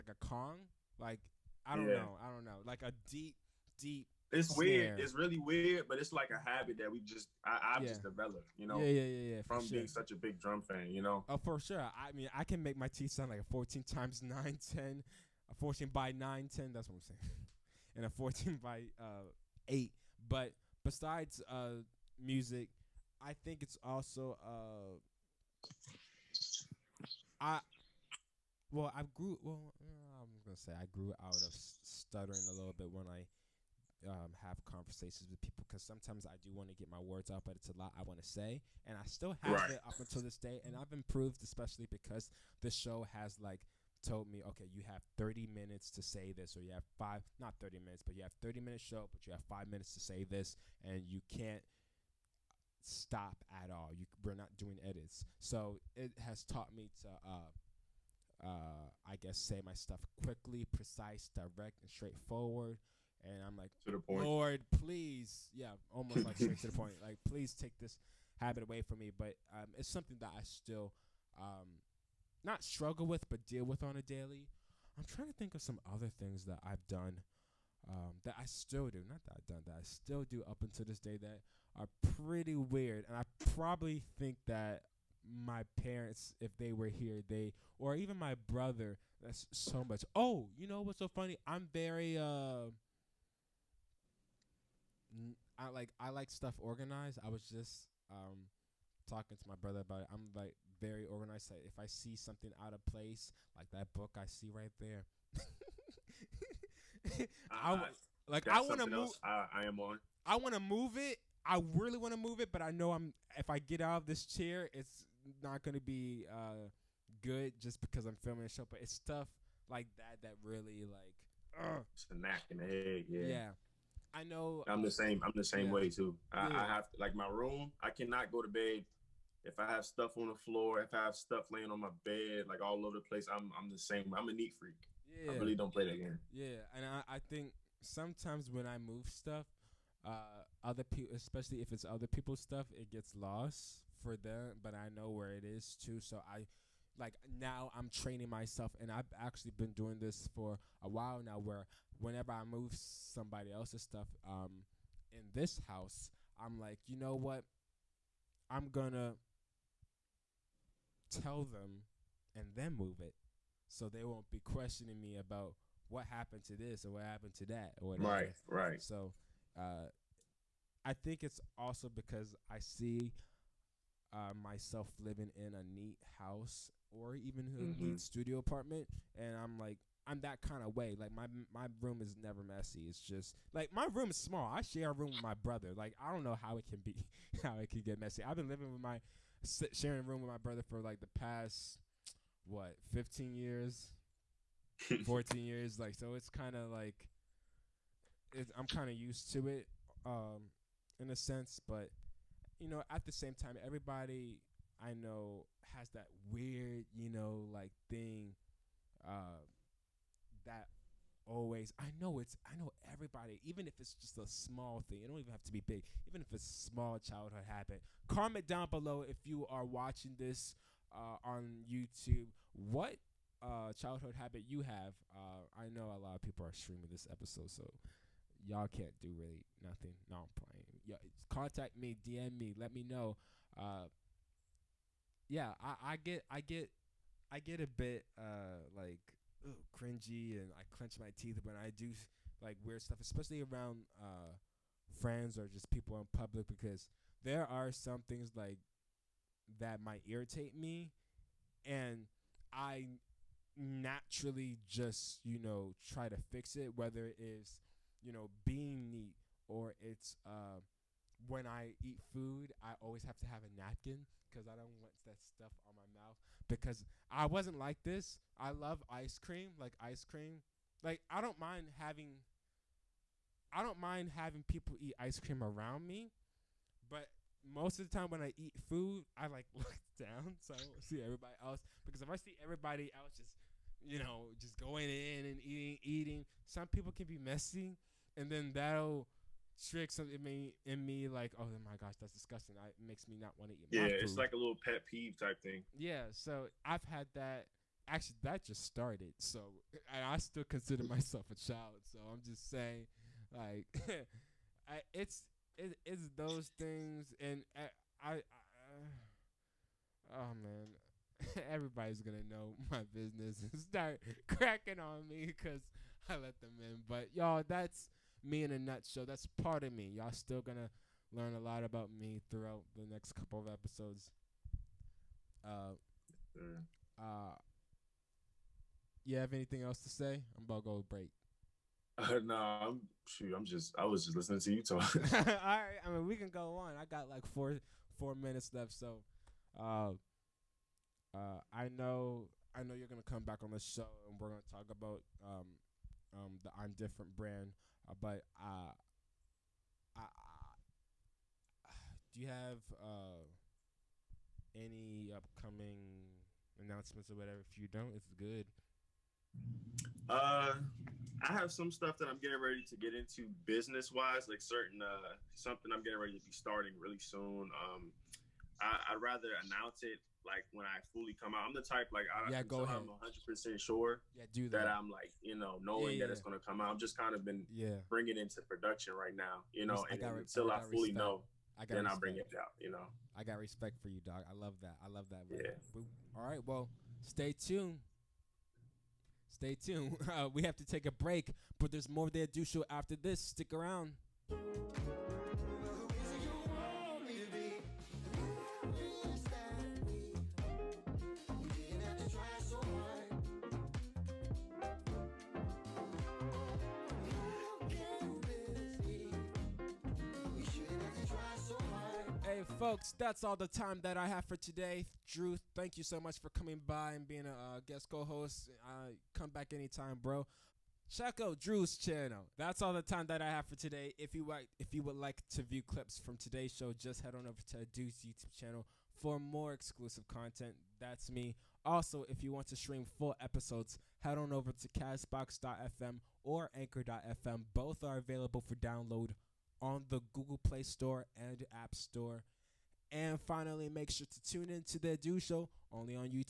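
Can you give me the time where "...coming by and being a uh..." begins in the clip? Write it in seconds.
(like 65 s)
416 s.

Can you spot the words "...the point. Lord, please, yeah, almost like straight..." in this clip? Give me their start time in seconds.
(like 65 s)
63 s.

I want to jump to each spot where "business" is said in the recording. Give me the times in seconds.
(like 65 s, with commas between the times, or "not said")
312 s, 363 s.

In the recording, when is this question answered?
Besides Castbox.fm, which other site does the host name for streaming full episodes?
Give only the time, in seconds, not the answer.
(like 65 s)
436 s.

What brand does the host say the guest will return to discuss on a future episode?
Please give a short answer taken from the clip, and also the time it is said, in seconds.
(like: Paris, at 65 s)
I'm Different, at 346 s.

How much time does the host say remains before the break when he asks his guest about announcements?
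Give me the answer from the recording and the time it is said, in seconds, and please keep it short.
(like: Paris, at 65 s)
4 minutes, at 337 s.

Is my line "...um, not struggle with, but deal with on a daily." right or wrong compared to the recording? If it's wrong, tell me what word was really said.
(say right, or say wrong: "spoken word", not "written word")
right.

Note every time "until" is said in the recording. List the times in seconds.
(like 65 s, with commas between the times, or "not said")
39 s, 80 s, 380 s.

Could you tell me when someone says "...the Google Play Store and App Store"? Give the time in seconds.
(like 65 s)
439 s.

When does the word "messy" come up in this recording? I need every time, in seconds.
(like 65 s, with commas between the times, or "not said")
182 s, 187 s, 287 s.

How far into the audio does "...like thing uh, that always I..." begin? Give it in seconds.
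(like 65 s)
207 s.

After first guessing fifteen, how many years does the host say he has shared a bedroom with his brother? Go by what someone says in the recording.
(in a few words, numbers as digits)
14.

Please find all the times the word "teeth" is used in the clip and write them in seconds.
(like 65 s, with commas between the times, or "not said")
12 s, 241 s.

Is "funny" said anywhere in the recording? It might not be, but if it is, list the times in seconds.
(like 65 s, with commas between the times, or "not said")
91 s.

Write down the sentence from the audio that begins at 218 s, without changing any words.
Comment down below if you are watching this uh, on YouTube.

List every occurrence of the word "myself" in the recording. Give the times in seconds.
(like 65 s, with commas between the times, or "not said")
148 s, 174 s, 300 s.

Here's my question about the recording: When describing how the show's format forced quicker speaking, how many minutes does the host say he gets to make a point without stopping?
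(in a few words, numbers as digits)
5.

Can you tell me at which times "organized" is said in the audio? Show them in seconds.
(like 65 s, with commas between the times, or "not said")
96 s, 101 s.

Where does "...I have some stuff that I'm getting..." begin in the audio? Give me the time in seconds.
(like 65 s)
361 s.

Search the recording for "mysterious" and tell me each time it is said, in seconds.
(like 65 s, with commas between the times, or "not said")
not said.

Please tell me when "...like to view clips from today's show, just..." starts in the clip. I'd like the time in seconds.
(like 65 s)
424 s.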